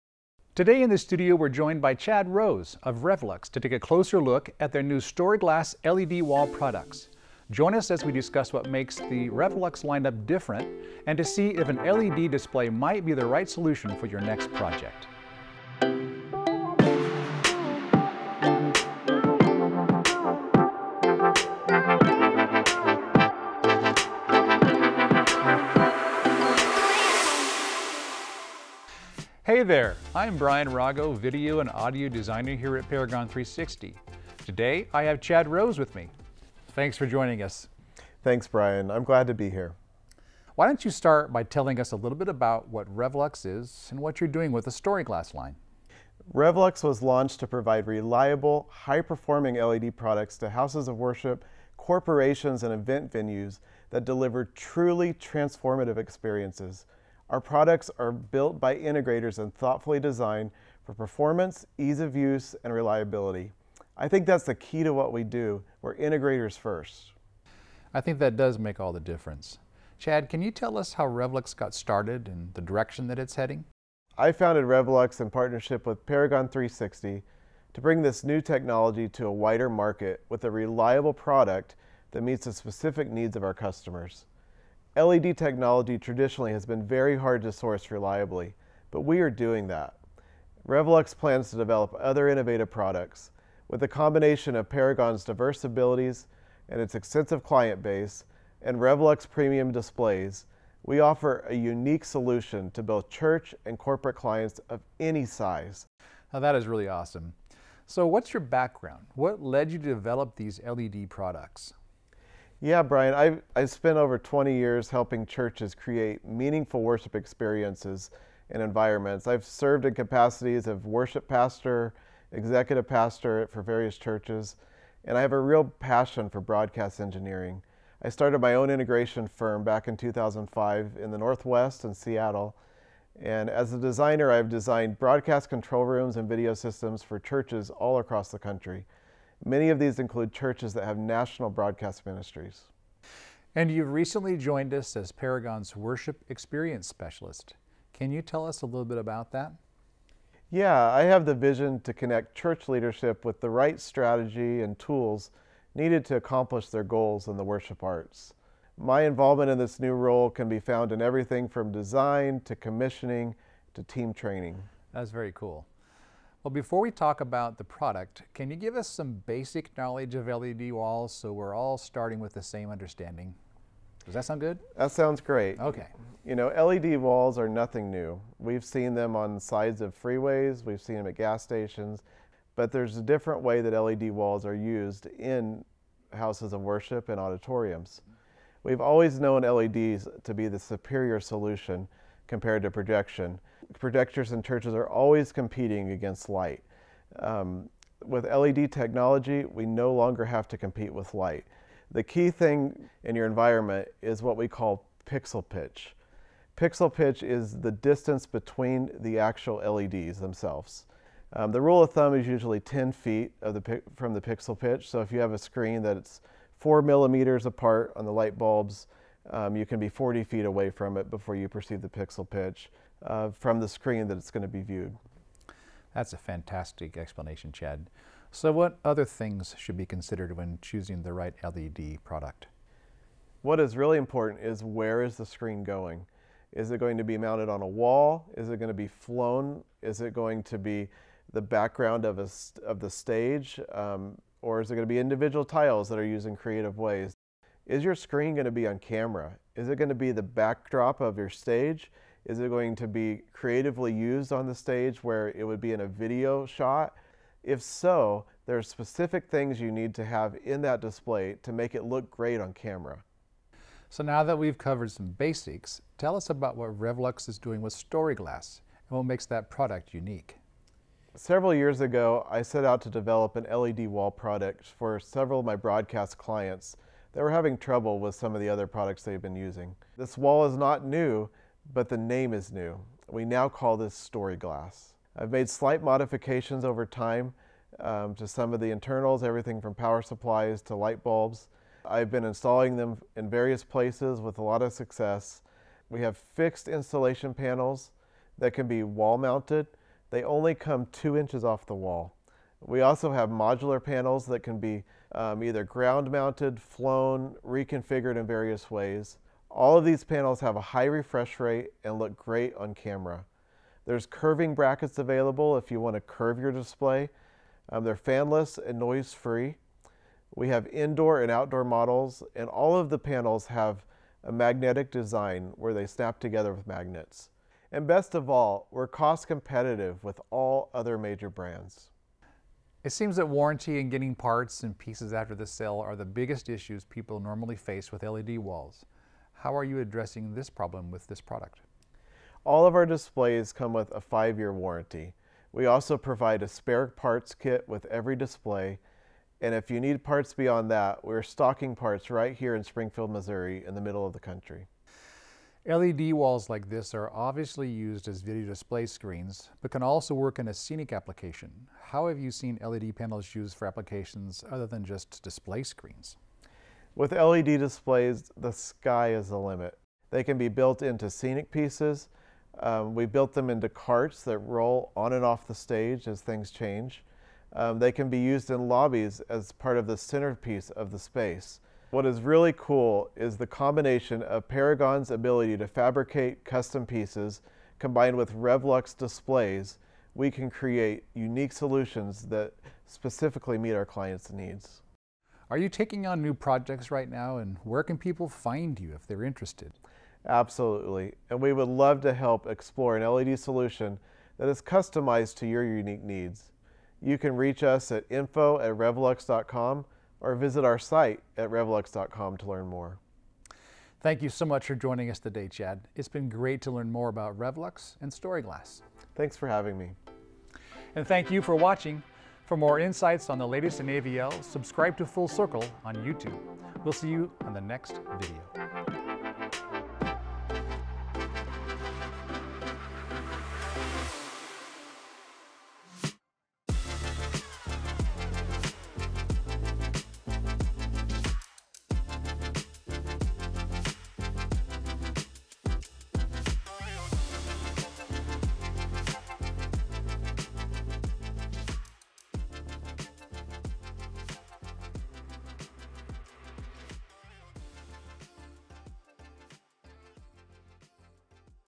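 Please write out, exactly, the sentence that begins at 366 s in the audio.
With LED displays, the sky is the limit.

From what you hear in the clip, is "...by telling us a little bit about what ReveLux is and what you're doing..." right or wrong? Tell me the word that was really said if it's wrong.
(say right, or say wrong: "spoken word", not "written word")
right.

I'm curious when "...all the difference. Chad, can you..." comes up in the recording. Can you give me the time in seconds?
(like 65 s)
68 s.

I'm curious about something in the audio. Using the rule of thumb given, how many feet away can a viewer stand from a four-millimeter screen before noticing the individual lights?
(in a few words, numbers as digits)
40 feet.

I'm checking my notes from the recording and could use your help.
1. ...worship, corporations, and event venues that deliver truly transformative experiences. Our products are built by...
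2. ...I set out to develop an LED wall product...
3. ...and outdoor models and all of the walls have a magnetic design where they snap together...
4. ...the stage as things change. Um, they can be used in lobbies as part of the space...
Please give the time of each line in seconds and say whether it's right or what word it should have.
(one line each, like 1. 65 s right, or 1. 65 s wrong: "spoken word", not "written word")
1. 50 s right
2. 272 s right
3. 321 s wrong: "panels", not "walls"
4. 375 s wrong: "centerpiece", not "space".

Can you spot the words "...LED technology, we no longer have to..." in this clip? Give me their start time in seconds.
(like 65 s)
198 s.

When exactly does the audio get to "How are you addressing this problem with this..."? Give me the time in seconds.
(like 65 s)
339 s.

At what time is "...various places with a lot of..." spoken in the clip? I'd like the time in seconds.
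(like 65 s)
293 s.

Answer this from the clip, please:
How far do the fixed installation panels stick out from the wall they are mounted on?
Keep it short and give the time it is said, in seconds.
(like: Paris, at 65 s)
2 inches, at 300 s.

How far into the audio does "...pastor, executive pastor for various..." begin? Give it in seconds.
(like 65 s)
121 s.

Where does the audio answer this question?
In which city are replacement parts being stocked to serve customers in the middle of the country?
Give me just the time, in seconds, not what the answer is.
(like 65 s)
352 s.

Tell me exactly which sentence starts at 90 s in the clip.
ReveLux plans to develop other innovative products.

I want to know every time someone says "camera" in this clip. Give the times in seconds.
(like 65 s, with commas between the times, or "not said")
248 s, 262 s, 312 s.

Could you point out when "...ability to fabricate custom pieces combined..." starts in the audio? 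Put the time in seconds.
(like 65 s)
385 s.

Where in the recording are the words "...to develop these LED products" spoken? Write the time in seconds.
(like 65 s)
109 s.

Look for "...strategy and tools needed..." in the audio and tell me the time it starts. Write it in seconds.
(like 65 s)
153 s.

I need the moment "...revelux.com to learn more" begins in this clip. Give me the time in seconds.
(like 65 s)
411 s.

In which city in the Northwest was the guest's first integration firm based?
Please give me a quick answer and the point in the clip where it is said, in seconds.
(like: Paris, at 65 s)
Seattle, at 131 s.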